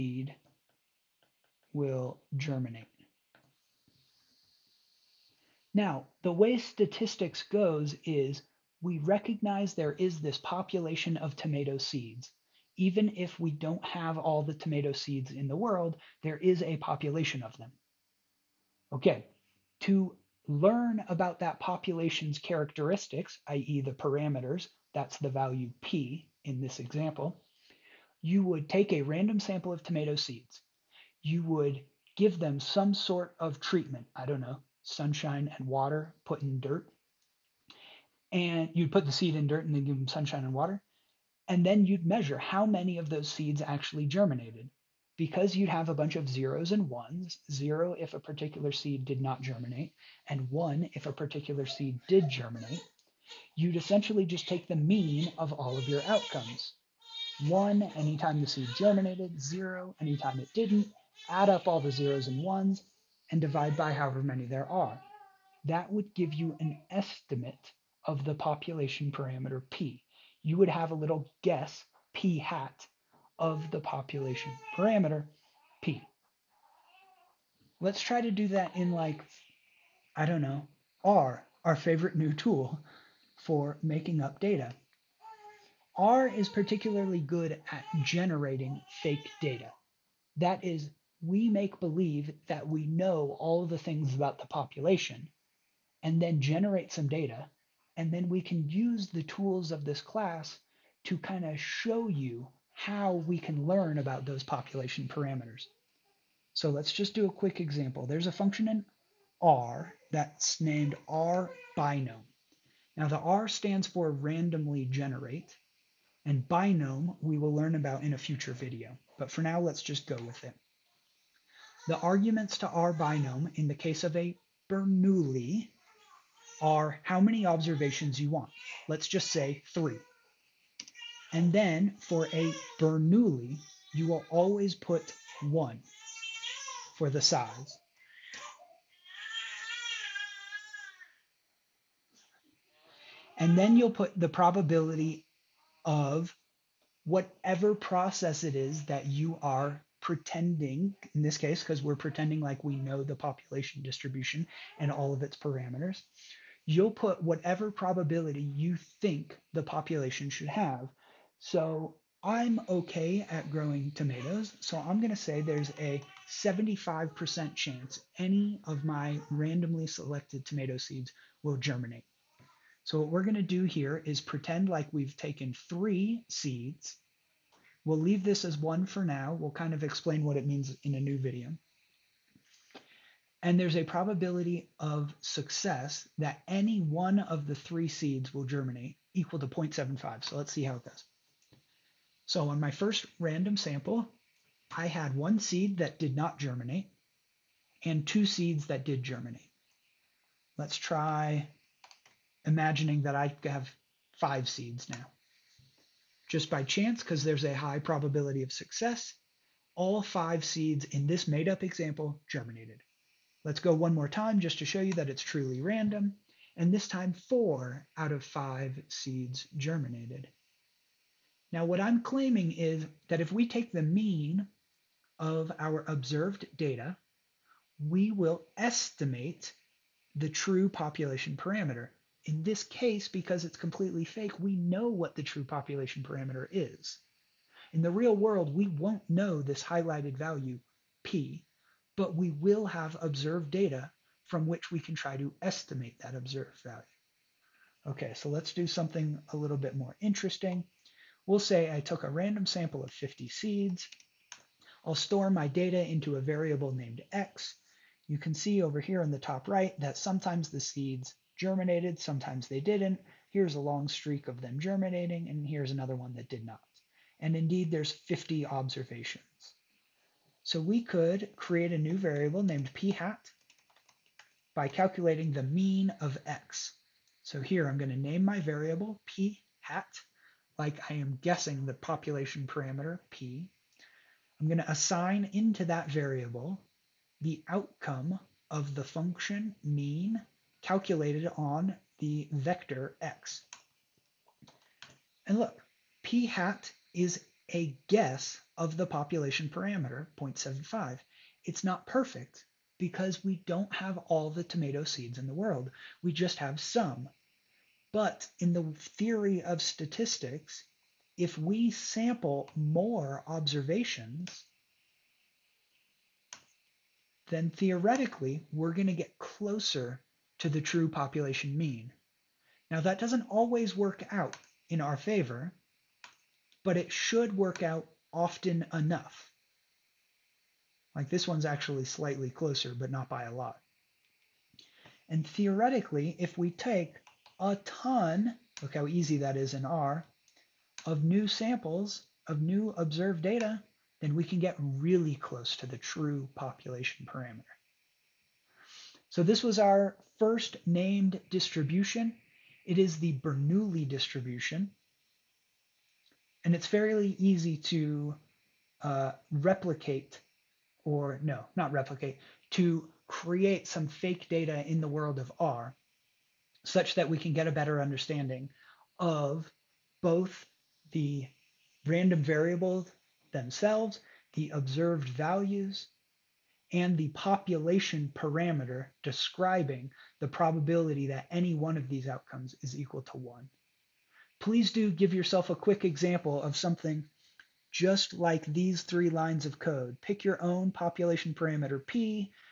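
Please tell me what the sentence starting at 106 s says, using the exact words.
So let's just do a quick example.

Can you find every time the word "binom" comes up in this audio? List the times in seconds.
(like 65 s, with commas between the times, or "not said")
111 s, 116 s, 122 s.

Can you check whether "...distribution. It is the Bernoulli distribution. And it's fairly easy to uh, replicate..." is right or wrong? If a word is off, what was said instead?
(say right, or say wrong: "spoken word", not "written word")
right.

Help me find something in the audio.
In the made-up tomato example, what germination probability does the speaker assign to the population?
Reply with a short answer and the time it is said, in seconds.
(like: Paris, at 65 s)
0.75, at 166 s.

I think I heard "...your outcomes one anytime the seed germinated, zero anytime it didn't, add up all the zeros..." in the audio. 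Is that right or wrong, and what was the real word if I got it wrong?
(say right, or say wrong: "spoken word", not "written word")
right.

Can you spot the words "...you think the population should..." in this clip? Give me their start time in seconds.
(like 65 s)
158 s.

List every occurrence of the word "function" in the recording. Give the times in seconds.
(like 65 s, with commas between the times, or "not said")
108 s, 288 s.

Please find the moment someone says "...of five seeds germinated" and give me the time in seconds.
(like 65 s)
218 s.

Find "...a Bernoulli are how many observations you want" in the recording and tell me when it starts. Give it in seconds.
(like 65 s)
124 s.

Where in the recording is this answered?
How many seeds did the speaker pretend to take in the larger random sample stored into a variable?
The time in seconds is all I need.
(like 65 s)
252 s.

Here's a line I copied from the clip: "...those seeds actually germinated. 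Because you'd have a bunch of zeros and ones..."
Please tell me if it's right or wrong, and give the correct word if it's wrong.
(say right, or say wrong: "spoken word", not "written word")
right.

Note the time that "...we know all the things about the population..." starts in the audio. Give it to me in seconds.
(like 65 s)
92 s.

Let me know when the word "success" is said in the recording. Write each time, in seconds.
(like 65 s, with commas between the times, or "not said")
185 s, 208 s.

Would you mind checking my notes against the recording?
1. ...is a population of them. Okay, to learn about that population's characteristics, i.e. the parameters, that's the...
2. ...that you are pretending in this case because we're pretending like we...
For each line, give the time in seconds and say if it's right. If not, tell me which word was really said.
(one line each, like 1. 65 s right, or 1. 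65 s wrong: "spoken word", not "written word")
1. 16 s right
2. 148 s right.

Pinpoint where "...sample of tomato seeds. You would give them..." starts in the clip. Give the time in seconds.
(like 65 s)
29 s.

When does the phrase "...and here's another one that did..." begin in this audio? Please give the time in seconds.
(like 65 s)
265 s.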